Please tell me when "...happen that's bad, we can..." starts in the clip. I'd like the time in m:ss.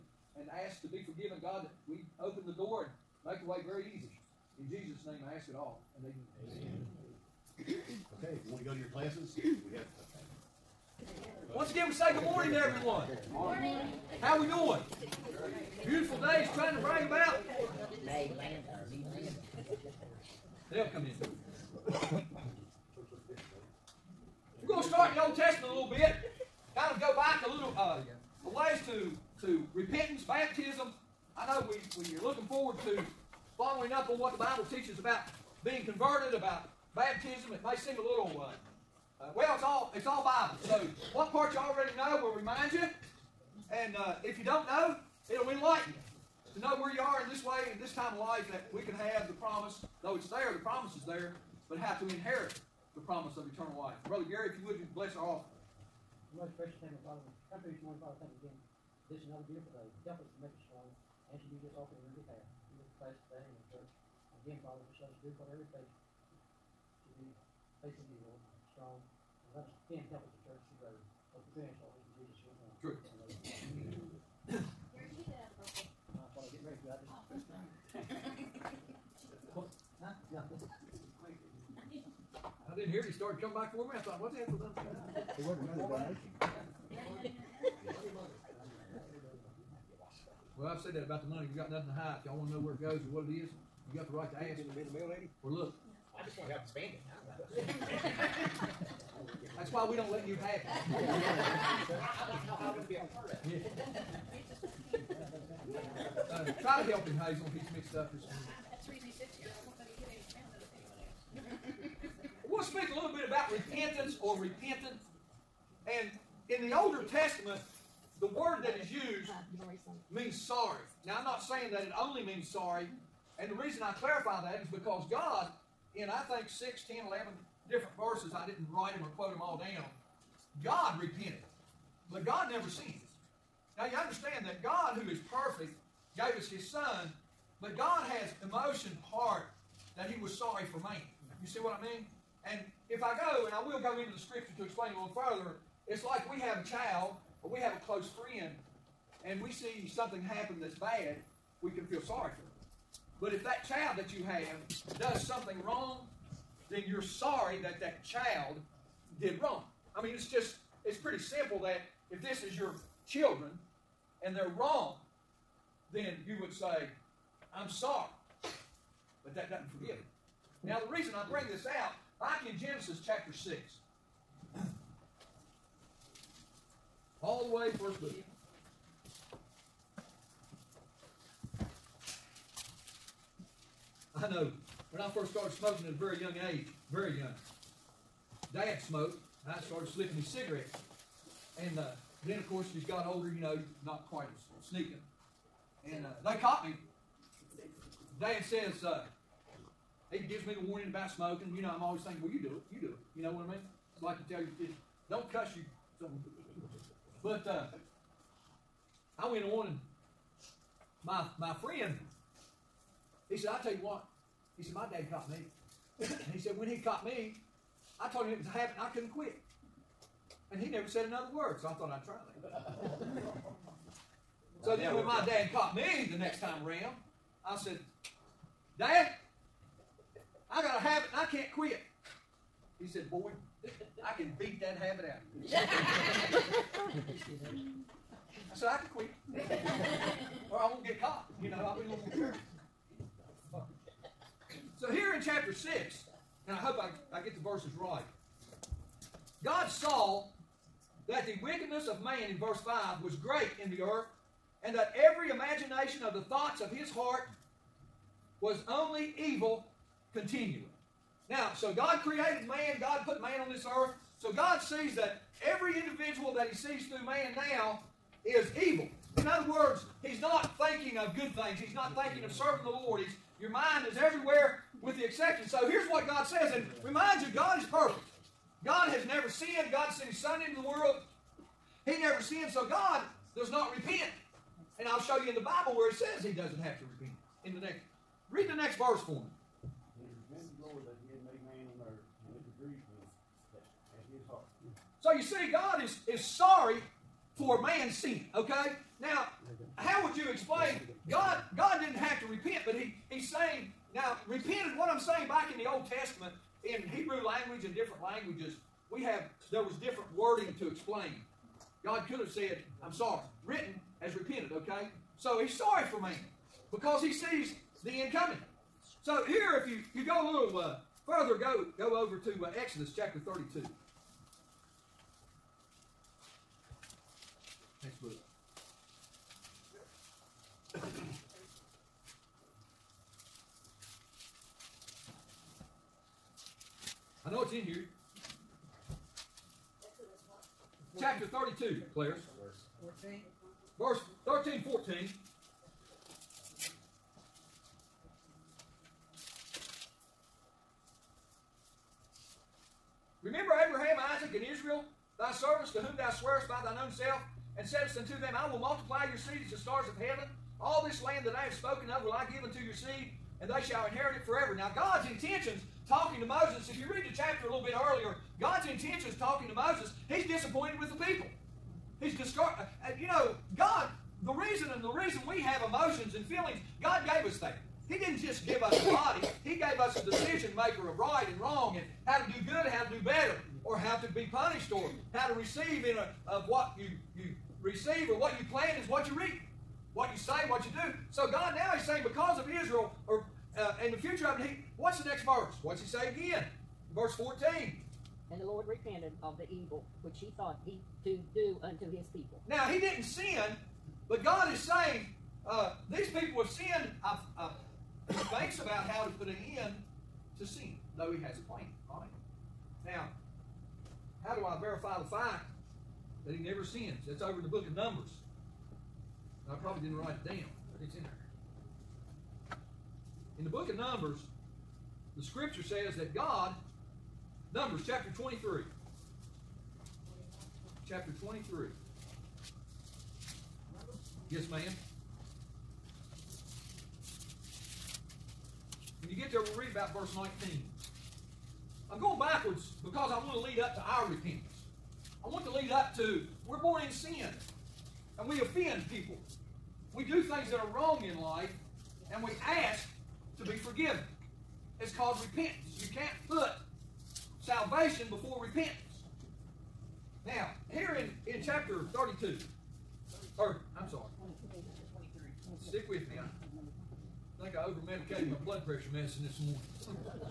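2:30.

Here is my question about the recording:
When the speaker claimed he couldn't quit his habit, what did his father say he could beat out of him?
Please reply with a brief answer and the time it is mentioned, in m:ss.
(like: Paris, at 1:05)
that habit, at 3:54.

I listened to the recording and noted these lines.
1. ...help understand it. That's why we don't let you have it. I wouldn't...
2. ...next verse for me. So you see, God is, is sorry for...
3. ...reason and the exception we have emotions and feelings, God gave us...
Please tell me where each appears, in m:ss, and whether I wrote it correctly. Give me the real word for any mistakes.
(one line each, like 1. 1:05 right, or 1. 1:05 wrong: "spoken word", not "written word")
1. 1:36 wrong: "spend", not "understand"
2. 4:48 right
3. 6:14 wrong: "reason", not "exception".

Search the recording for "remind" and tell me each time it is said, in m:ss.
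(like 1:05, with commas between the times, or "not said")
0:42, 4:36.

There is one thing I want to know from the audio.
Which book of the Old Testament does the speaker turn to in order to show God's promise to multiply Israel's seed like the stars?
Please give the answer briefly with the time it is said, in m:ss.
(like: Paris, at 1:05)
Exodus, at 5:22.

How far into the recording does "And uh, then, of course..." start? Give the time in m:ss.
3:11.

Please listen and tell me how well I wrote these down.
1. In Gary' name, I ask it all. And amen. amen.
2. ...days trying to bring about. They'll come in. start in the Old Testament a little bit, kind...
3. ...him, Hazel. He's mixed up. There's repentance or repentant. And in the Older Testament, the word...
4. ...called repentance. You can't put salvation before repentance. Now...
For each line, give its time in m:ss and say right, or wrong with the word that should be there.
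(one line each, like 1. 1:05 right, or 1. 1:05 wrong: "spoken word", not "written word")
1. 0:04 wrong: "Jesus", not "Gary"
2. 0:16 right
3. 1:47 right
4. 7:34 right.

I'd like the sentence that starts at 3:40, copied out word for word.
And he never said another word, so I thought I'd try that.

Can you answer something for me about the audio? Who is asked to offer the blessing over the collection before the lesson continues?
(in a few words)
Brother Gary.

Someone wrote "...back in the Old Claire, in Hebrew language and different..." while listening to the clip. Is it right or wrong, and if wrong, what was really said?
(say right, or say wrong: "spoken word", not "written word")
wrong: "Testament", not "Claire".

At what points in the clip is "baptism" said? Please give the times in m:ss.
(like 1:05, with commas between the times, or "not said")
0:30, 0:36.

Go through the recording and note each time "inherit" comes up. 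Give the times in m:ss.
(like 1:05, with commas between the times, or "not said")
0:52, 6:03.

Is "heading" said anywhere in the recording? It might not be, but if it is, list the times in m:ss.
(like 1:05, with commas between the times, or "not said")
not said.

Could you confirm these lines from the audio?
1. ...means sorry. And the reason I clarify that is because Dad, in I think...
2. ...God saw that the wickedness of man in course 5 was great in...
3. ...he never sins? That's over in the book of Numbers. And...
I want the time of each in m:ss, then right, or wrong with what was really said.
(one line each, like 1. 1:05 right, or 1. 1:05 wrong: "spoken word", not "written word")
1. 2:02 wrong: "God", not "Dad"
2. 4:09 wrong: "verse", not "course"
3. 6:56 right.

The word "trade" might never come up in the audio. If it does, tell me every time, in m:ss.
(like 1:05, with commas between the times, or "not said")
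not said.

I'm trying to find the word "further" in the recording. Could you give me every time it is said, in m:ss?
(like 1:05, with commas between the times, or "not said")
2:25, 5:21.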